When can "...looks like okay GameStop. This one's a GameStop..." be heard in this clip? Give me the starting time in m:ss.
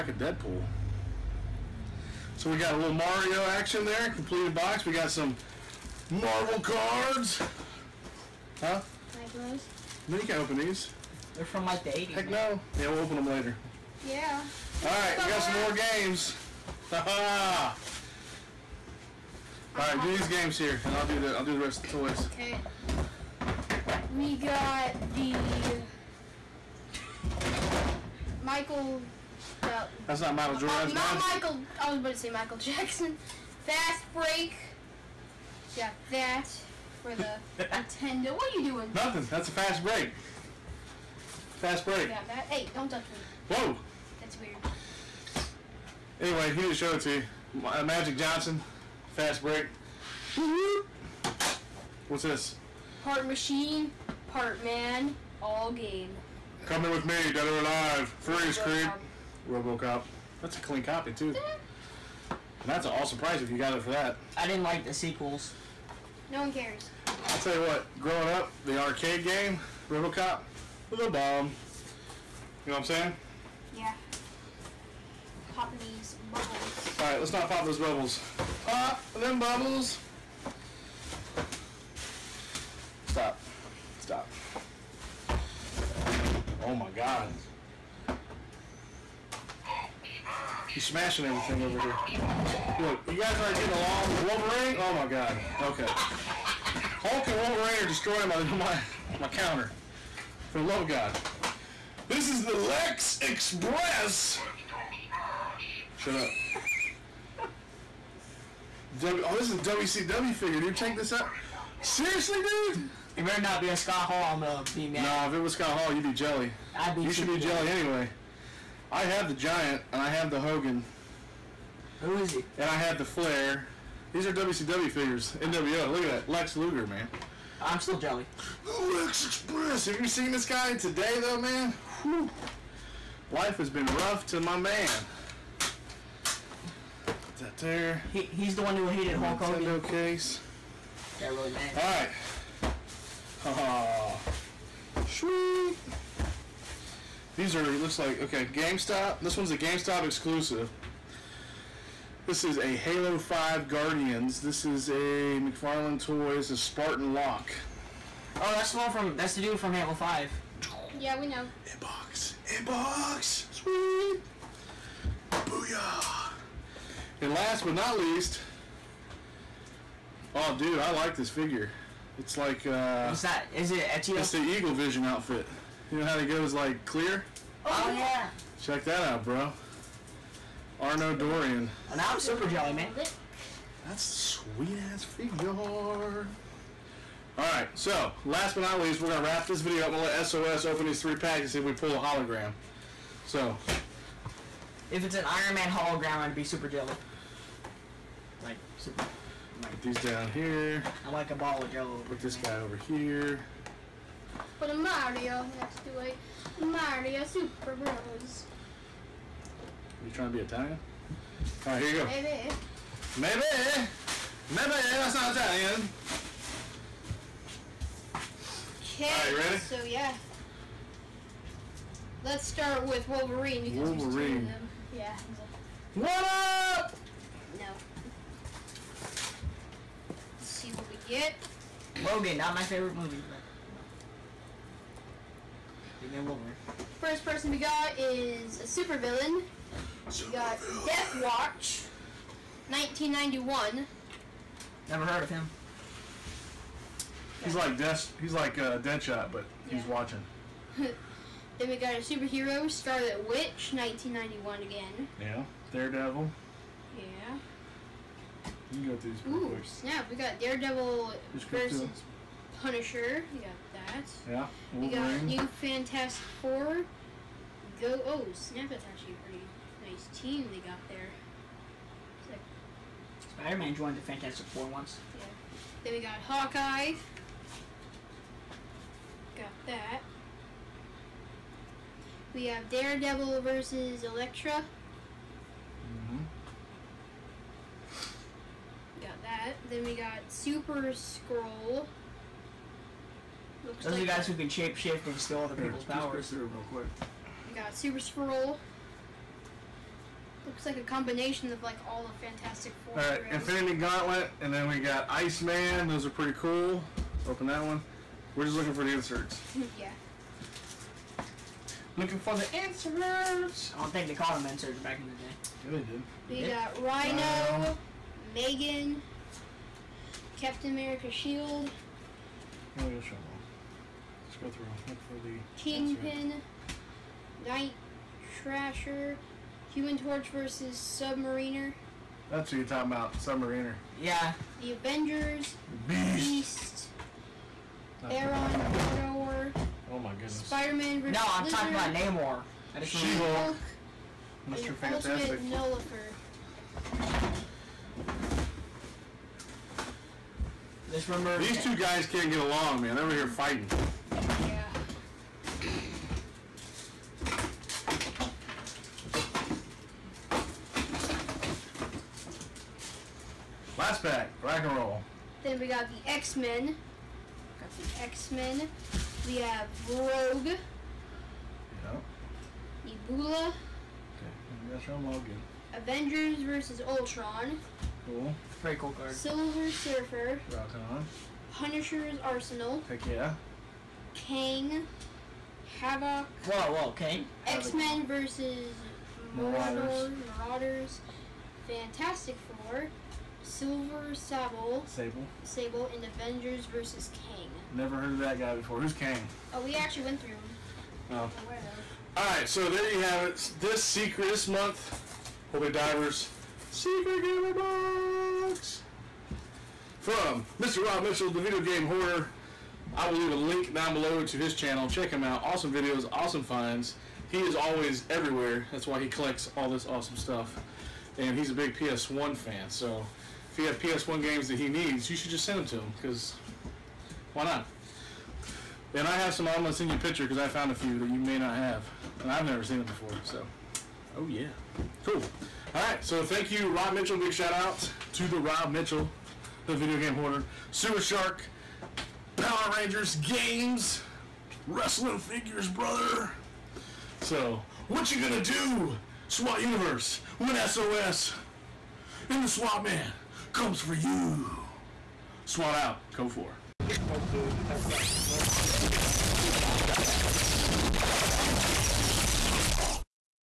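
2:27.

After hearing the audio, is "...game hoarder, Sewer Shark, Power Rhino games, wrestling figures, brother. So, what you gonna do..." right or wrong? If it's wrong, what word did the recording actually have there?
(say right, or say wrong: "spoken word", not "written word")
wrong: "Rangers", not "Rhino".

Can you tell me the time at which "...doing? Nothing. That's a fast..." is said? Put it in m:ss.
0:38.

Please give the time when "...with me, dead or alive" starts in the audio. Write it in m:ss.
0:56.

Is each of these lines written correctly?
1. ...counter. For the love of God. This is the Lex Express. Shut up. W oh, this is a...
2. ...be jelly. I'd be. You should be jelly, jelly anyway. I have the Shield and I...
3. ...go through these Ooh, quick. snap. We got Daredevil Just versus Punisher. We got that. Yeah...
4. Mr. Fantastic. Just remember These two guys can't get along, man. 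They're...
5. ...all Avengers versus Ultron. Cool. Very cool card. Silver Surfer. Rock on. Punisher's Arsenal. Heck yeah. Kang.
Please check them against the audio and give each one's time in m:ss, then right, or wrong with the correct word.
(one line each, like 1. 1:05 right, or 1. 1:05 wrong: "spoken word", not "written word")
1. 1:39 right
2. 1:56 wrong: "Giant", not "Shield"
3. 4:18 right
4. 5:44 right
5. 6:15 right.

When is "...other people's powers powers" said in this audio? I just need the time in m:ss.
4:55.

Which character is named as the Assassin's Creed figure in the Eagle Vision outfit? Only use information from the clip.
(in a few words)
Arno Dorian.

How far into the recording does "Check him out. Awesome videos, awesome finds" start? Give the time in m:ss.
6:54.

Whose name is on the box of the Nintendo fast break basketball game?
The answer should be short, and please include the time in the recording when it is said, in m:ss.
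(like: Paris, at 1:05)
Magic Johnson, at 0:47.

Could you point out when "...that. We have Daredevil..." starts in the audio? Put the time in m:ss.
4:39.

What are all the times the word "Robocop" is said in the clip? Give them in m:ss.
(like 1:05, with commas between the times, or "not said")
0:59, 1:09.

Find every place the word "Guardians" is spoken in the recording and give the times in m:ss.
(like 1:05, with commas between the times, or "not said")
2:33.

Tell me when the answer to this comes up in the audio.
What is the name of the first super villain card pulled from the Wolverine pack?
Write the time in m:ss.
4:00.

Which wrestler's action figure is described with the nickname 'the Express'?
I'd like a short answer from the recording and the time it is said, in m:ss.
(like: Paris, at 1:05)
Lex Luger, at 2:06.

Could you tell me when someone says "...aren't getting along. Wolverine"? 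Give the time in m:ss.
1:33.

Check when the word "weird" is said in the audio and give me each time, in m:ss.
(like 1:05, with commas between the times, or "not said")
0:44.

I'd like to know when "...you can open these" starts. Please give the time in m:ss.
0:10.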